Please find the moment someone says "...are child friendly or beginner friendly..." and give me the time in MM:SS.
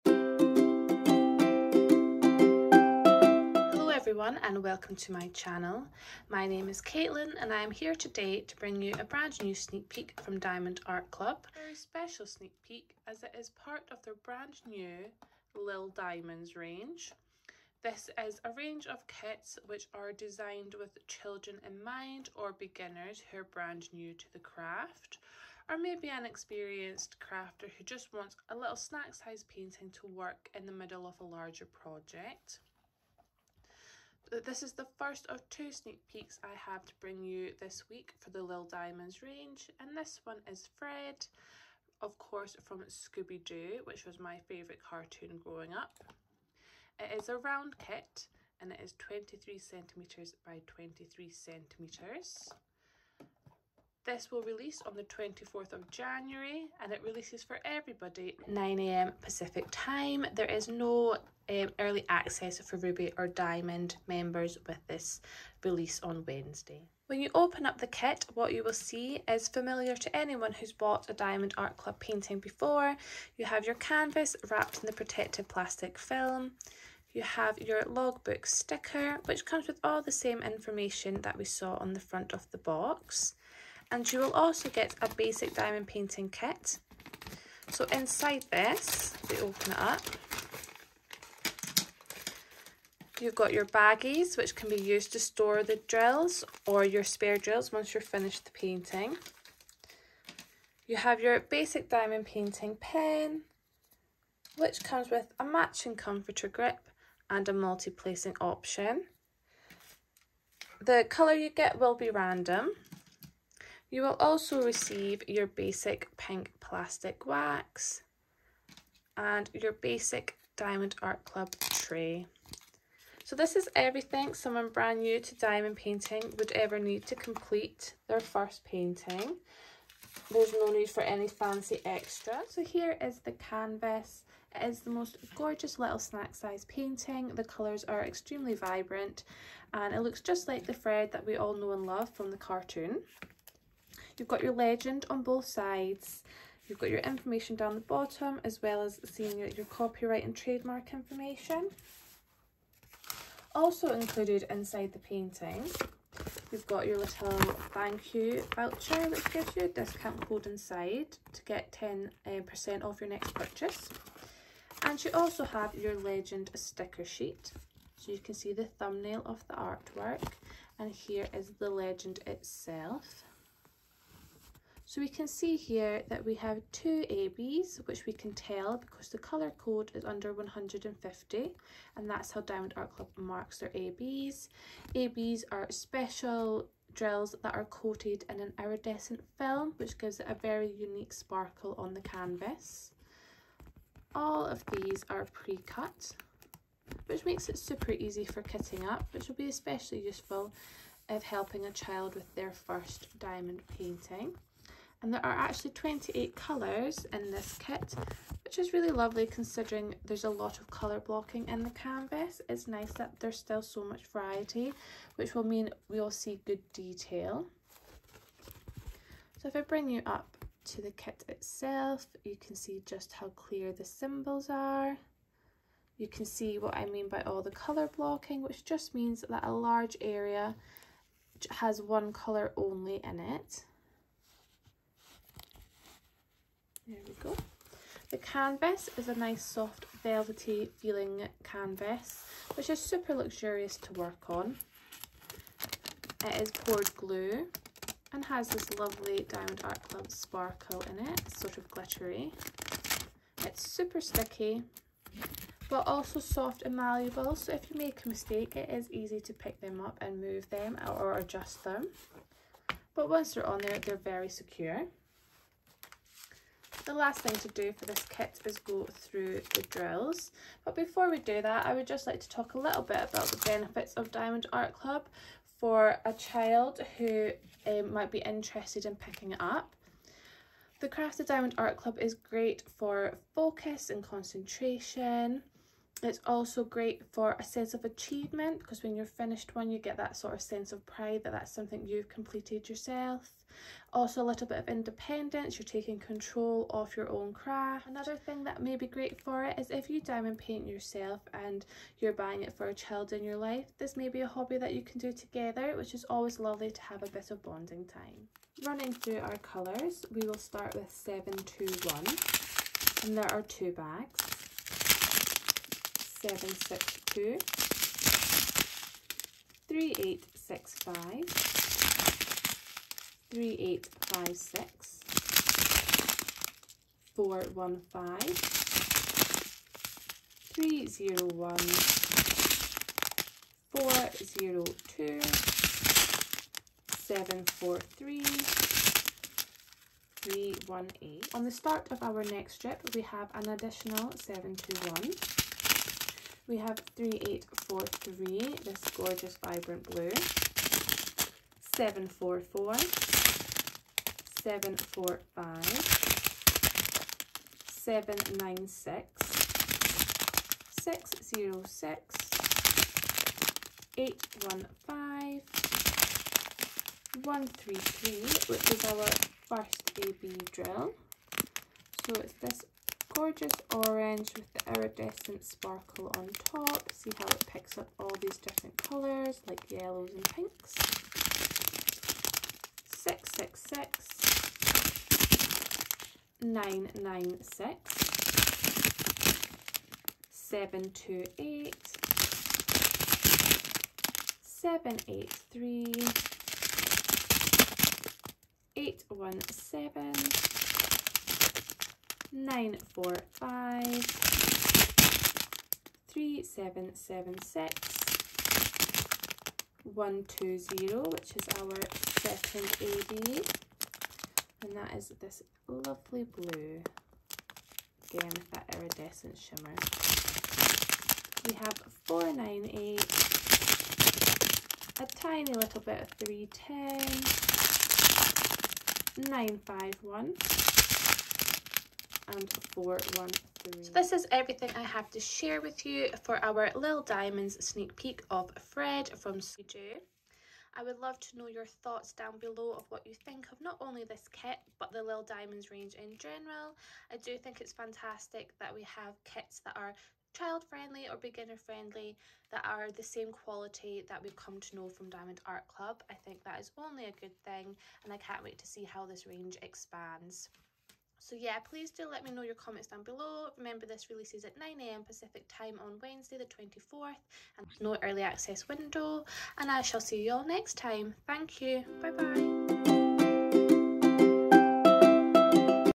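07:29.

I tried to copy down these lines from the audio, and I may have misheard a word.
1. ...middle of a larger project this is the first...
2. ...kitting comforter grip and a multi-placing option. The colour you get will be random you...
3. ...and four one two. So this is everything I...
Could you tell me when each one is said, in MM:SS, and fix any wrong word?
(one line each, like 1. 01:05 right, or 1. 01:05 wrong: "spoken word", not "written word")
1. 00:30 right
2. 01:45 wrong: "matching", not "kitting"
3. 07:12 wrong: "three", not "two".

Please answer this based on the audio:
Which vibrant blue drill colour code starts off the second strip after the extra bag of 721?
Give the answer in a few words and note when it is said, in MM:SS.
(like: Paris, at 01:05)
3843, at 05:46.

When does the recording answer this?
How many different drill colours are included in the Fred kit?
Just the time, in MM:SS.
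03:25.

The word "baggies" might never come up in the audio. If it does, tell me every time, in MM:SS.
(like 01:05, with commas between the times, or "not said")
01:33.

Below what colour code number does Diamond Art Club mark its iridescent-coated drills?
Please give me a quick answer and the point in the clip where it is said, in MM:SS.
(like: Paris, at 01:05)
150, at 03:00.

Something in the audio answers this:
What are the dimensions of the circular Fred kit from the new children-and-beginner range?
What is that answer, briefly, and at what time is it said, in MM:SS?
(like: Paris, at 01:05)
23 cm by 23 cm, at 00:48.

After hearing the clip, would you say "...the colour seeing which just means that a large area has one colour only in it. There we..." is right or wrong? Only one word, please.
wrong.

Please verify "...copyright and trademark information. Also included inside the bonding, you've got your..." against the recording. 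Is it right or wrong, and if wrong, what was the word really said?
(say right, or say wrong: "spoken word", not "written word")
wrong: "painting", not "bonding".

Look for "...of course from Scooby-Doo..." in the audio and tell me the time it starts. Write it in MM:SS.
00:42.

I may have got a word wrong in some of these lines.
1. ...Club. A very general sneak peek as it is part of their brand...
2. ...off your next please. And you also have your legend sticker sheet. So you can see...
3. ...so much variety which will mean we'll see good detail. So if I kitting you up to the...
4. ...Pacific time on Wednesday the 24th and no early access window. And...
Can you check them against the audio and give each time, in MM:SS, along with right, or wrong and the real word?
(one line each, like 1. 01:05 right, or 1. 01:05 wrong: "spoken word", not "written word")
1. 00:11 wrong: "special", not "general"
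2. 02:42 wrong: "purchase", not "please"
3. 03:33 wrong: "bring", not "kitting"
4. 07:45 right.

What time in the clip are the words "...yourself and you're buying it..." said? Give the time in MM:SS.
05:00.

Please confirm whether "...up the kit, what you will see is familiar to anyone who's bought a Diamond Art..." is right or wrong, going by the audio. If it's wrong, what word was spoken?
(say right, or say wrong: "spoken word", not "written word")
right.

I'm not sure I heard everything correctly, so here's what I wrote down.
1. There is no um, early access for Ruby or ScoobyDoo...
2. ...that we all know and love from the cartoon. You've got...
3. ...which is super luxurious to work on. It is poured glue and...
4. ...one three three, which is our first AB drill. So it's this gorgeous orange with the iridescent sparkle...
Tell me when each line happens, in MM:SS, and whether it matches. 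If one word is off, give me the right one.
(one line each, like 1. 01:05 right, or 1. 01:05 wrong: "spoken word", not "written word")
1. 01:00 wrong: "Diamond", not "ScoobyDoo"
2. 02:21 right
3. 04:02 right
4. 06:07 right.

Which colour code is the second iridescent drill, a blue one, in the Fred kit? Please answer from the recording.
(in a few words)
120.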